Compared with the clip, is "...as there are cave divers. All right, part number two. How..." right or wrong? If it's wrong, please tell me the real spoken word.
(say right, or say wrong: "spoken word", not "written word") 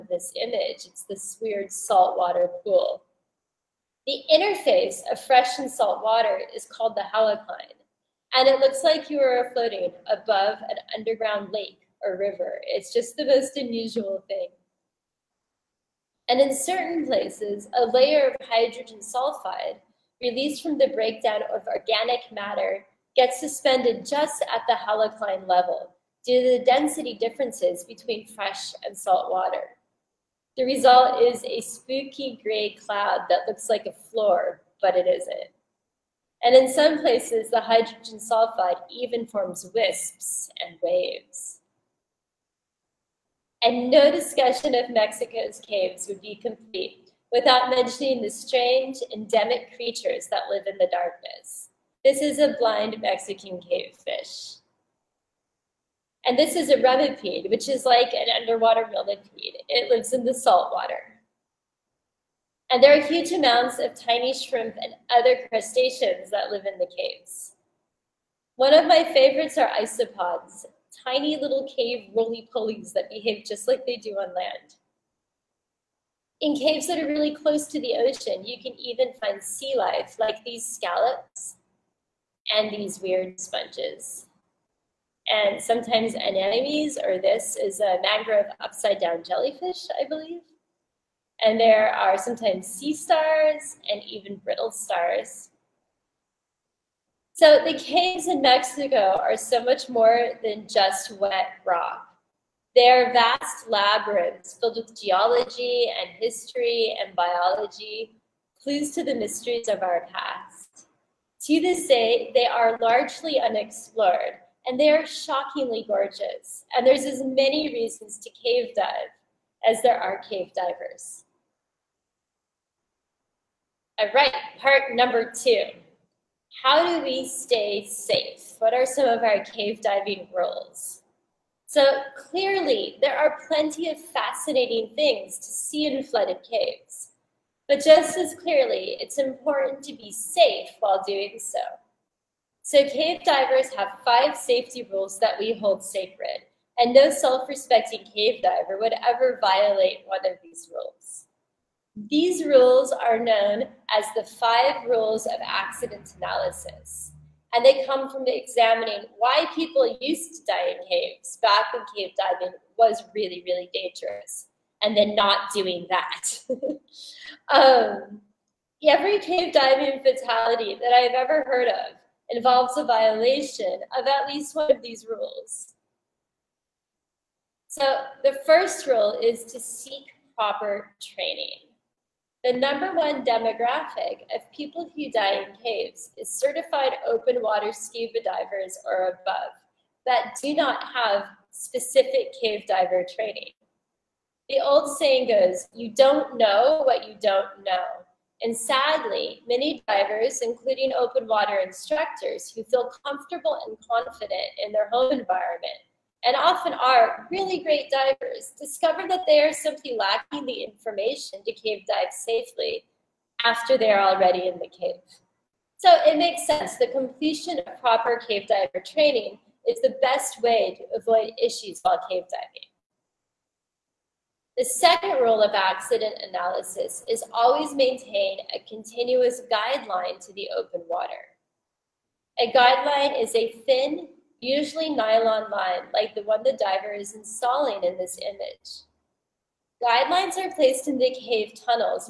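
right.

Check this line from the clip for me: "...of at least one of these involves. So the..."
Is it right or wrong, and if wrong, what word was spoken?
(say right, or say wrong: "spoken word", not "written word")
wrong: "rules", not "involves".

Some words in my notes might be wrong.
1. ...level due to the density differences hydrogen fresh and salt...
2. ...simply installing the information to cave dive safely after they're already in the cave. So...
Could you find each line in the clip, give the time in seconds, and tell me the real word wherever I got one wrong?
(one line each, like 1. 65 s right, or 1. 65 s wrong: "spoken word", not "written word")
1. 25 s wrong: "between", not "hydrogen"
2. 209 s wrong: "lacking", not "installing".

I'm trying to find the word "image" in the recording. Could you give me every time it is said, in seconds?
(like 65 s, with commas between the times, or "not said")
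0 s, 238 s.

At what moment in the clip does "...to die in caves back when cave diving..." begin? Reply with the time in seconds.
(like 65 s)
160 s.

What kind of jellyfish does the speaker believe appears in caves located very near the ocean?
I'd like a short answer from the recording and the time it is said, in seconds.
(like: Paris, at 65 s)
Mangrove upside down jellyfish, at 88 s.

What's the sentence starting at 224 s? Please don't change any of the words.
The second rule of accident analysis is always maintain a continuous guideline to the open water.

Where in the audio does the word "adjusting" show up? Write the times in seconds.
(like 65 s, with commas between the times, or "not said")
not said.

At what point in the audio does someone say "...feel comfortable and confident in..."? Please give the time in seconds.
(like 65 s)
202 s.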